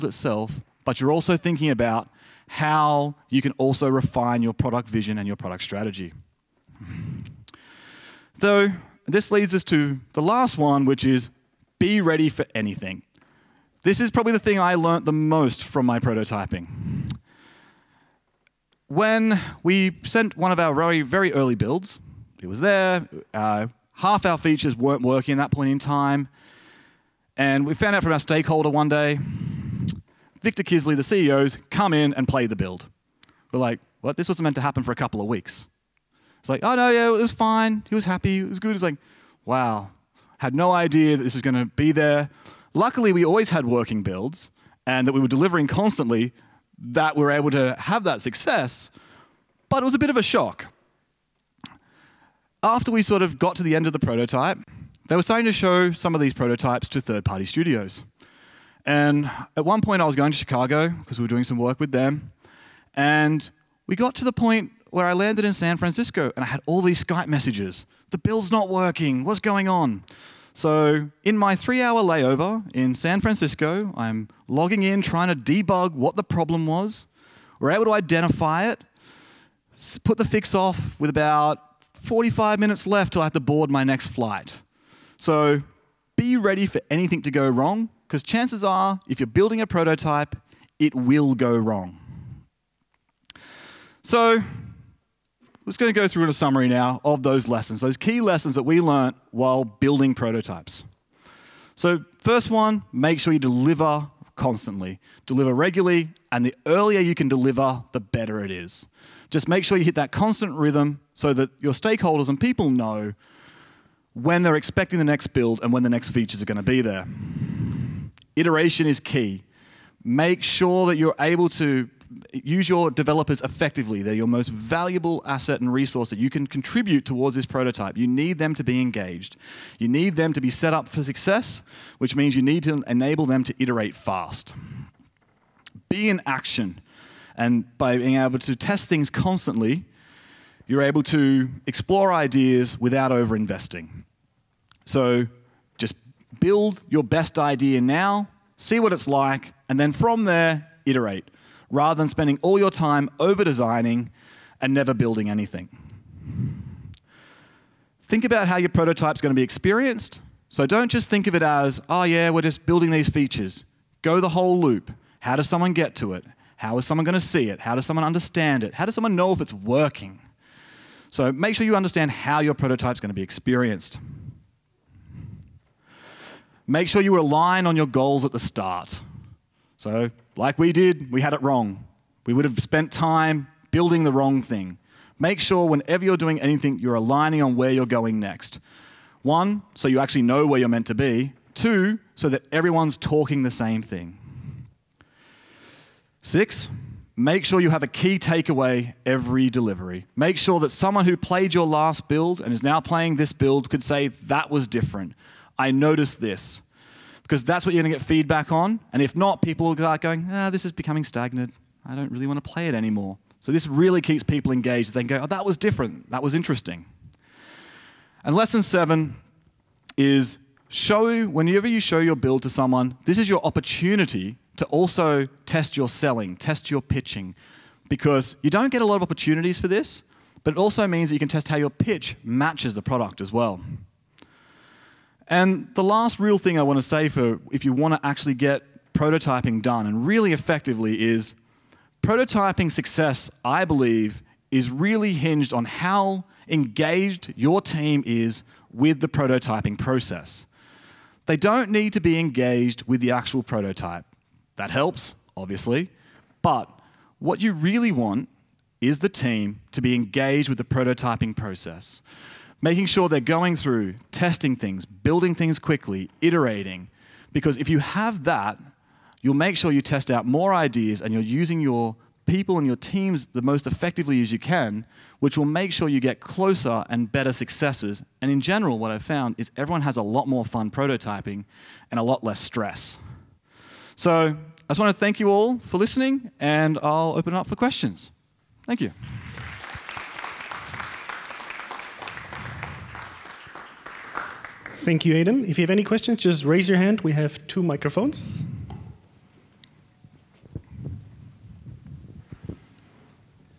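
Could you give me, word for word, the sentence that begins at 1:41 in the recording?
So, first one, make sure you deliver constantly, deliver regularly, and the earlier you can deliver, the better it is.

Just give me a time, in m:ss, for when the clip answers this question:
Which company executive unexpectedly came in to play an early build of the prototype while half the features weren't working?
0:30.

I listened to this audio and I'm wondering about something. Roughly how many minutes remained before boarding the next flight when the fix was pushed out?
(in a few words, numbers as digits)
45.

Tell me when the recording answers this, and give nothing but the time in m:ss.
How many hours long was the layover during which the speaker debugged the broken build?
1:11.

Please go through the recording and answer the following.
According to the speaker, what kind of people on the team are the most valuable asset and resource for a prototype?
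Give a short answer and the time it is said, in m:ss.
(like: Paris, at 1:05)
developers, at 2:02.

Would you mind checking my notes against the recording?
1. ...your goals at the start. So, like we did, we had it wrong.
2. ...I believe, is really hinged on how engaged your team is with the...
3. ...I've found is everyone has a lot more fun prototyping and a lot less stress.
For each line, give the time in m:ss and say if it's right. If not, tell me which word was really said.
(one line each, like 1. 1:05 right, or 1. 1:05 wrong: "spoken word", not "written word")
1. 2:57 right
2. 4:03 right
3. 4:38 right.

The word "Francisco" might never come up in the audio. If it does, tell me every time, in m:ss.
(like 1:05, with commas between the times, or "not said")
1:05, 1:13.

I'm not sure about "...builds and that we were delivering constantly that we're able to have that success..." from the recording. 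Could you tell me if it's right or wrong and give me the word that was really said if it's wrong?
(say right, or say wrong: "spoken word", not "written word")
right.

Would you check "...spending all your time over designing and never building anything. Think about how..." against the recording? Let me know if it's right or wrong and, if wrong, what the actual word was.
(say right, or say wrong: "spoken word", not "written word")
right.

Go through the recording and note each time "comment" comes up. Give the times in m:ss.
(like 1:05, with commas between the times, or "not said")
not said.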